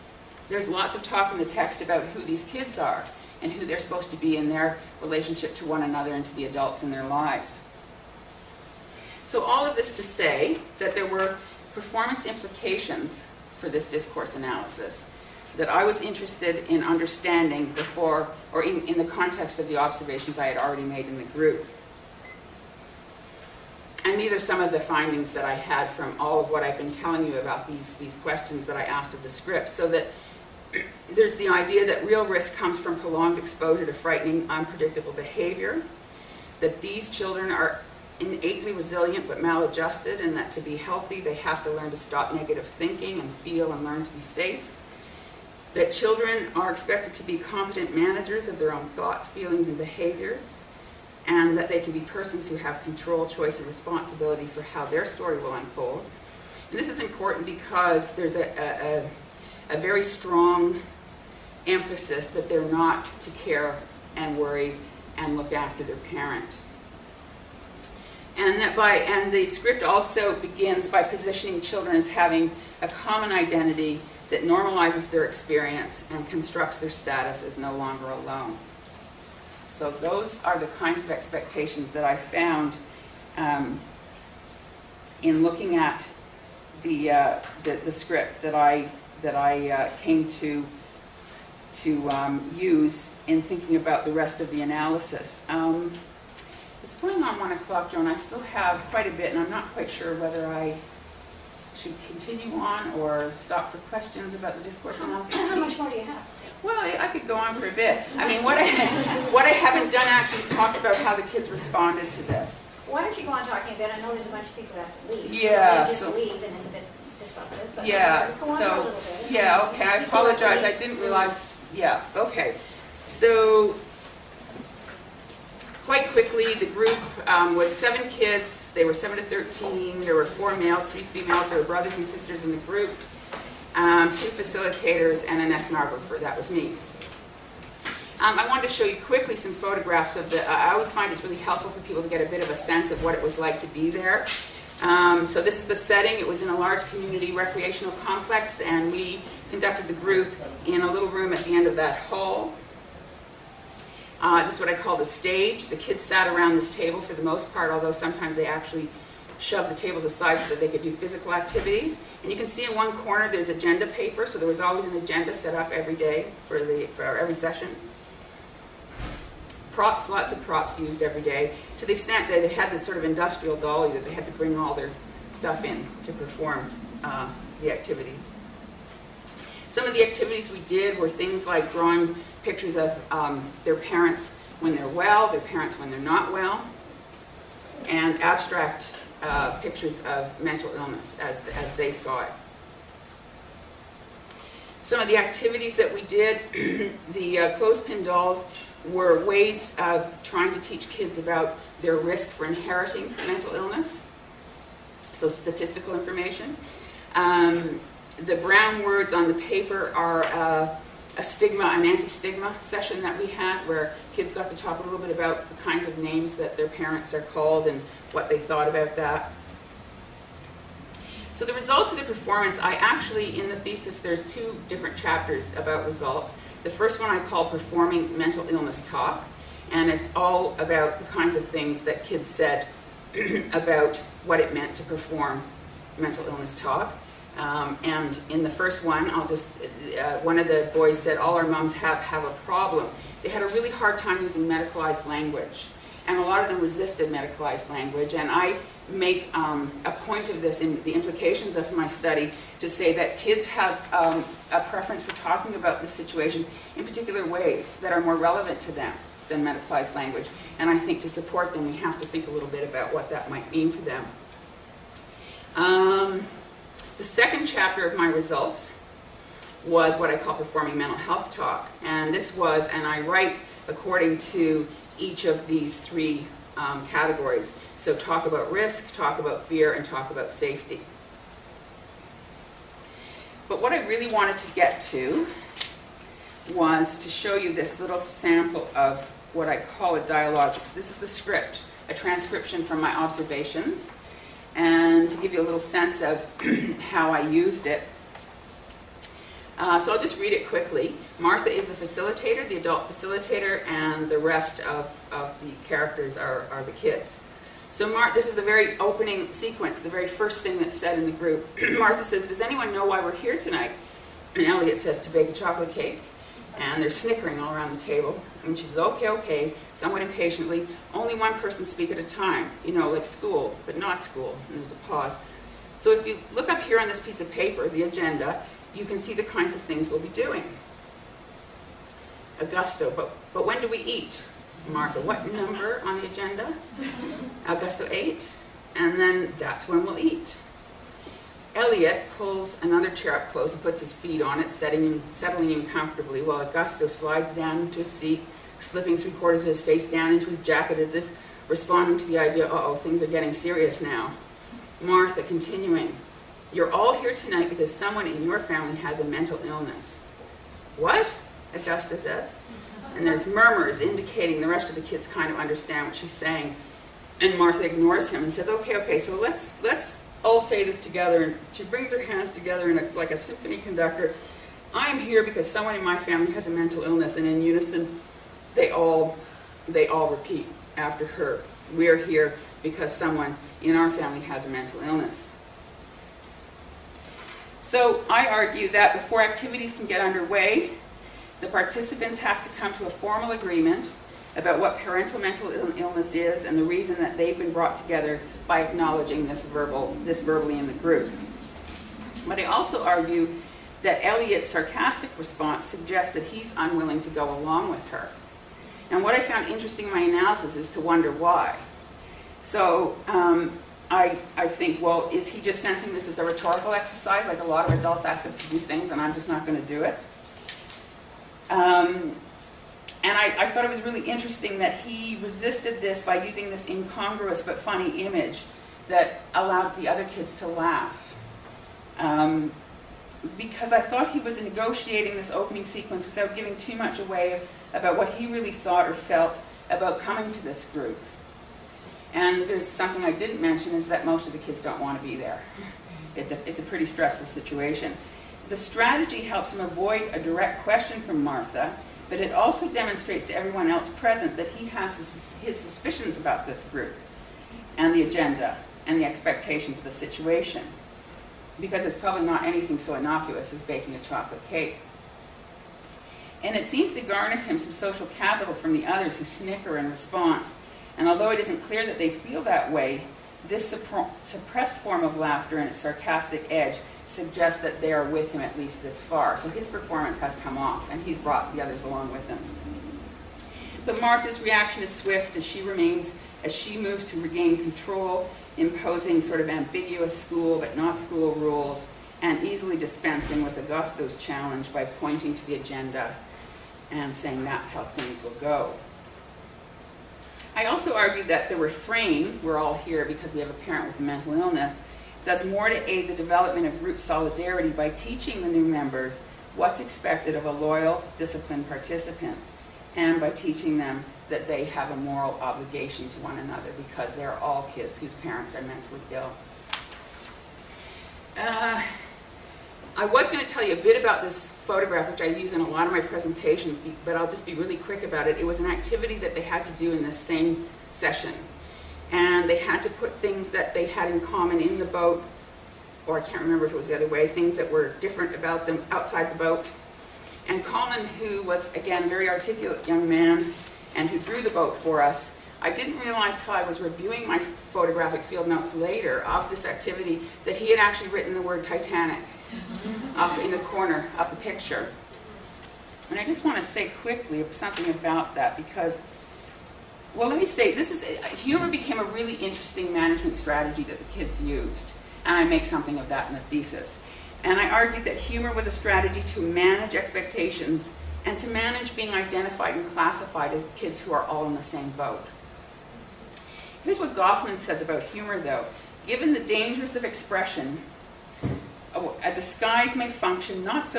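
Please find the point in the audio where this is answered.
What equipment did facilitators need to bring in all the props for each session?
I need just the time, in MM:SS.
02:53.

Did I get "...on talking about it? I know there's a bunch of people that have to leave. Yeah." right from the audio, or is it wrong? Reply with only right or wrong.
right.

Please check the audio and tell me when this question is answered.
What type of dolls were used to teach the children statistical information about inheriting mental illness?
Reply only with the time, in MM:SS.
03:17.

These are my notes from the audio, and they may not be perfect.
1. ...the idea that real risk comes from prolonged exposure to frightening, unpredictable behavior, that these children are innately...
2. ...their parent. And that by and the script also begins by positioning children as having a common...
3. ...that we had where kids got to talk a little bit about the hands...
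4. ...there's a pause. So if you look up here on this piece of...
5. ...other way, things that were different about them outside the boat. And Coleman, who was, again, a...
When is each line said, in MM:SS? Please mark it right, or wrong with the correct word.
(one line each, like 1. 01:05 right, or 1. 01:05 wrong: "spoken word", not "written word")
1. 00:31 right
2. 01:05 right
3. 03:33 wrong: "kinds", not "hands"
4. 05:24 right
5. 08:56 right.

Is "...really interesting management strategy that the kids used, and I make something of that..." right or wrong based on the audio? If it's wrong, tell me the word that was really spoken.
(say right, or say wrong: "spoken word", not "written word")
right.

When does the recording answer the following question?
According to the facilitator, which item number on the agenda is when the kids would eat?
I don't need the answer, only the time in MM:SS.
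05:37.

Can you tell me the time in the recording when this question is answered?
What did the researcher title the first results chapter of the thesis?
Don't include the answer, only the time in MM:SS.
03:47.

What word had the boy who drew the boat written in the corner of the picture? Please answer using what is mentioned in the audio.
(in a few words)
Titanic.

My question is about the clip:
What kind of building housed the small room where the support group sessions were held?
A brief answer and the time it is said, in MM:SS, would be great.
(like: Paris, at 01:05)
community recreational complex, at 02:26.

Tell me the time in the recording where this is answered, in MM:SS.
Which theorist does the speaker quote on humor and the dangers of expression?
09:37.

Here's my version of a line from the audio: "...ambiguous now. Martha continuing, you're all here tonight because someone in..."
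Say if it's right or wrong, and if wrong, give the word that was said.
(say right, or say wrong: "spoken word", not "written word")
wrong: "serious", not "ambiguous".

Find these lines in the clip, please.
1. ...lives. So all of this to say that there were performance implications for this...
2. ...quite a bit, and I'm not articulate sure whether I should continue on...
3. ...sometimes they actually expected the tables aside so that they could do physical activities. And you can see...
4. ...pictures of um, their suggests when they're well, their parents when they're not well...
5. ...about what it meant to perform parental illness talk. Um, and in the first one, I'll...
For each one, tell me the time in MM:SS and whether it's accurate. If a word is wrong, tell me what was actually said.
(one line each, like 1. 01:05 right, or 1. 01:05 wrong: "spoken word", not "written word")
1. 00:07 right
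2. 01:38 wrong: "quite", not "articulate"
3. 02:37 wrong: "shoved", not "expected"
4. 03:02 wrong: "parents", not "suggests"
5. 03:53 wrong: "mental", not "parental".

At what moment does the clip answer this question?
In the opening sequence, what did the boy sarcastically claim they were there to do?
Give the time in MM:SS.
05:15.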